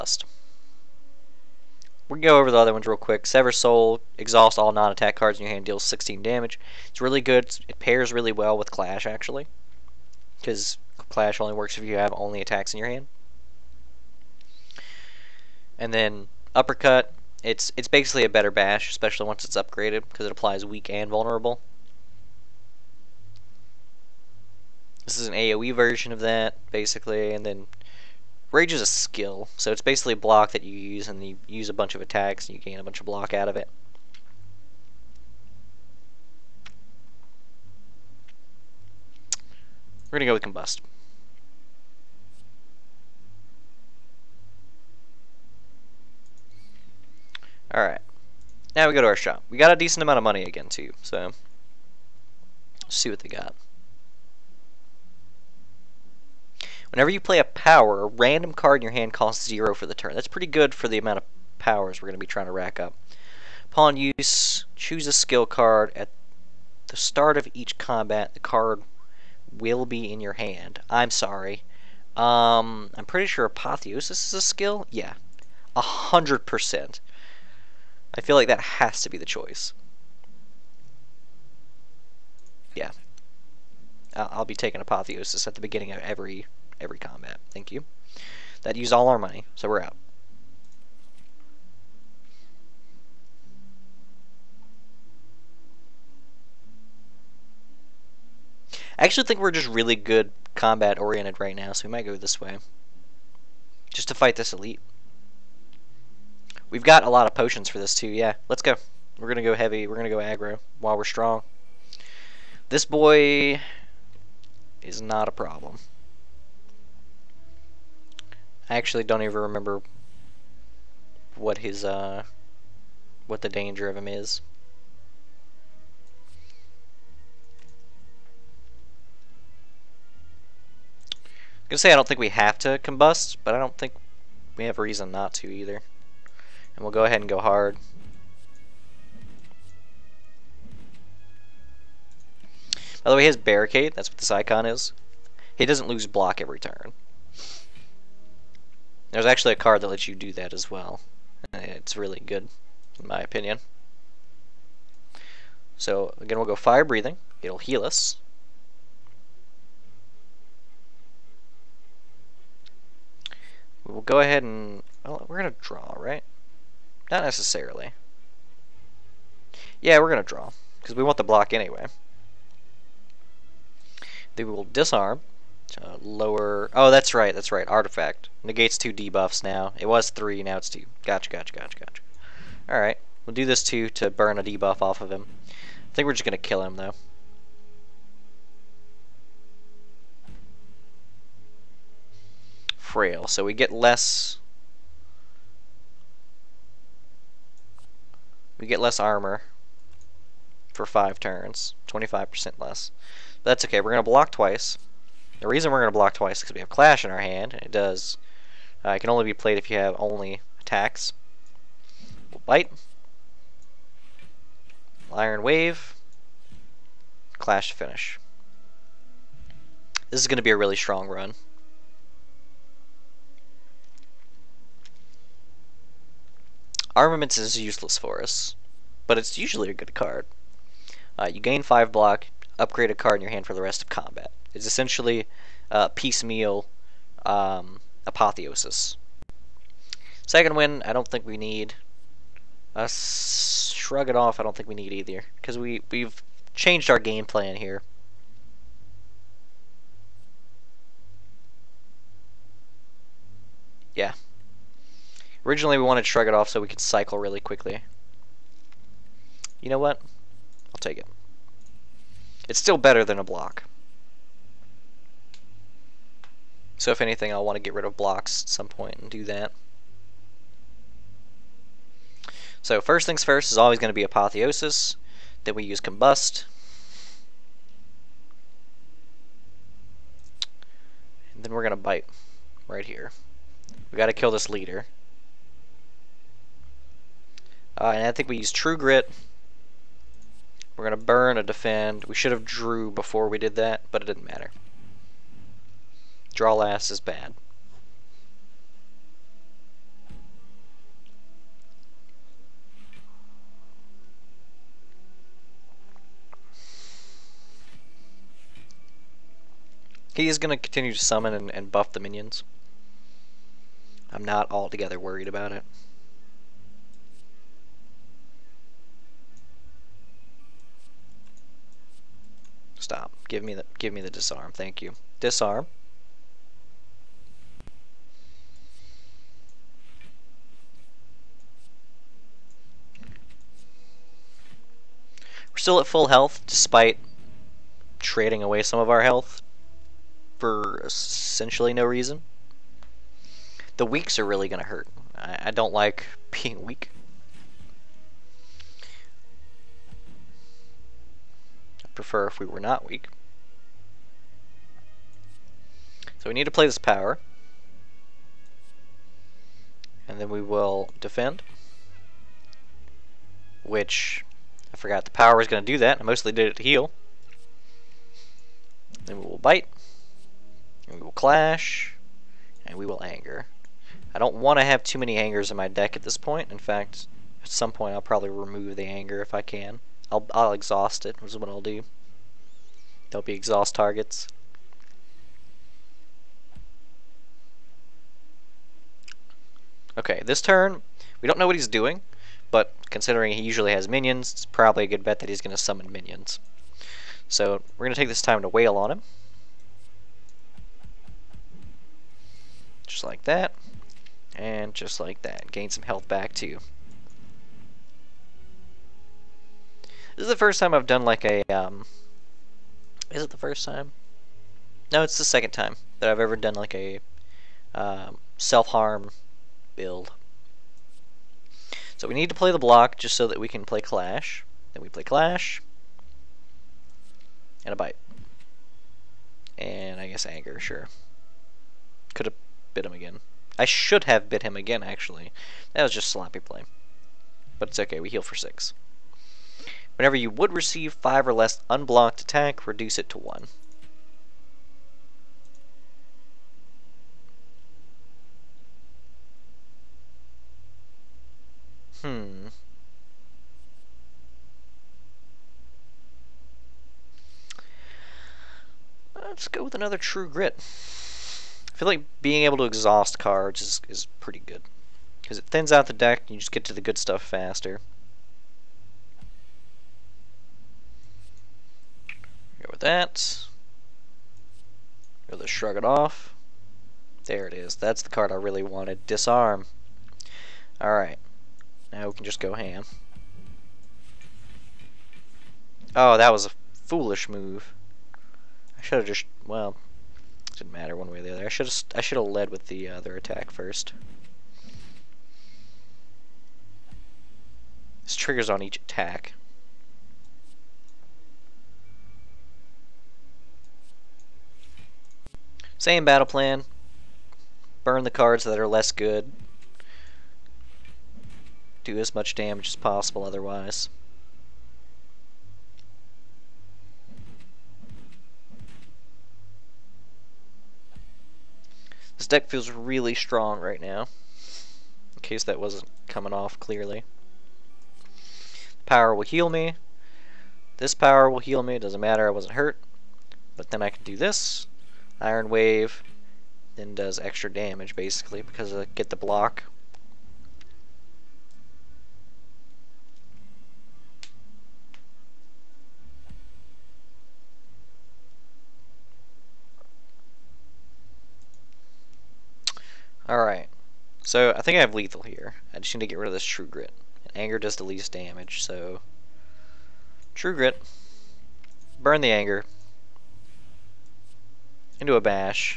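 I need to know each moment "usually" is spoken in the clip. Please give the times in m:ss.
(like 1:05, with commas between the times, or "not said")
3:49, 6:33.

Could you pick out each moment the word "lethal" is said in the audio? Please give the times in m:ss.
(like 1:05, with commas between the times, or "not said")
9:14.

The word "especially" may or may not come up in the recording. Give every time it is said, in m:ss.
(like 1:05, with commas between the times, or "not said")
0:18.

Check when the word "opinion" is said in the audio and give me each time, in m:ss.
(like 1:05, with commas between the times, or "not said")
2:33.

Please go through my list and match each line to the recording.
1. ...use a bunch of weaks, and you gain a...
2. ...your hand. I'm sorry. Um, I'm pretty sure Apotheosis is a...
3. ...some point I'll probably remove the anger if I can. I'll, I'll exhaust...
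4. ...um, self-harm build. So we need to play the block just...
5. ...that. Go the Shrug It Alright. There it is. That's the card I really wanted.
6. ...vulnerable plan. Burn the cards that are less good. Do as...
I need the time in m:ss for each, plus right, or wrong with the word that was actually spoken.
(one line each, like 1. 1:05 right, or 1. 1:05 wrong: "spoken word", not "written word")
1. 0:31 wrong: "attacks", not "weaks"
2. 1:10 right
3. 6:17 right
4. 6:57 right
5. 7:52 wrong: "Off", not "Alright"
6. 8:26 wrong: "battle", not "vulnerable".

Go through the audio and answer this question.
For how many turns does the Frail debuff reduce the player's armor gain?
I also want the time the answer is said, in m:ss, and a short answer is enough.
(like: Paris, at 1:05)
5, at 3:20.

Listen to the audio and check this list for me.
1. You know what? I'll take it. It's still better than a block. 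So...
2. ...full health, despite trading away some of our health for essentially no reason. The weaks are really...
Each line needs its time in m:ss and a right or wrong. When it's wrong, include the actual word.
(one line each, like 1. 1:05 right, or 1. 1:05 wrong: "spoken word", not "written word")
1. 4:19 right
2. 5:35 right.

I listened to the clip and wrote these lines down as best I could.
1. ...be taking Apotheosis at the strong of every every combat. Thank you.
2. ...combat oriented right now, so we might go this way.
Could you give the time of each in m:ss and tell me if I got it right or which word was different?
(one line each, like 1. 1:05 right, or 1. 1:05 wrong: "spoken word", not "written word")
1. 1:24 wrong: "beginning", not "strong"
2. 1:40 right.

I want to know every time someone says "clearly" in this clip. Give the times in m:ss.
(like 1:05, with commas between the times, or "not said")
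8:46.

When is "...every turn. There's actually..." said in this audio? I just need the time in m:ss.
2:26.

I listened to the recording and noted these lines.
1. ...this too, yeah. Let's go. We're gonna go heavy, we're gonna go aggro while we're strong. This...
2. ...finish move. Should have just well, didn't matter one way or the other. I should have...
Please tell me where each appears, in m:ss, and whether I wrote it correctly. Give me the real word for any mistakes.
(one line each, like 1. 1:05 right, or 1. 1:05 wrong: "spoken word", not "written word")
1. 1:47 right
2. 8:06 wrong: "foolish", not "finish".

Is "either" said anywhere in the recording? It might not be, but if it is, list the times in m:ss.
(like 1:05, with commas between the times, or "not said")
2:15, 4:04.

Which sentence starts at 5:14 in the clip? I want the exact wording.
I'm not altogether worried about it.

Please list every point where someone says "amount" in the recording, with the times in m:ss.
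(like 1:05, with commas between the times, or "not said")
0:50, 1:00.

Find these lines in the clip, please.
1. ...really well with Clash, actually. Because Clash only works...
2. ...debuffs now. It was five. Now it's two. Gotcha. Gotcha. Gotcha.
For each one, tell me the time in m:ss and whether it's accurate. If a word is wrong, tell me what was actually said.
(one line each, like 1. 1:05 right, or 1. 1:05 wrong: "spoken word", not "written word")
1. 0:08 right
2. 2:58 wrong: "three", not "five".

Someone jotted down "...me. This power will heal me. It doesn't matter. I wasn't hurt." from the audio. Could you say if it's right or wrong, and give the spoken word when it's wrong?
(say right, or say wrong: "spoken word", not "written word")
right.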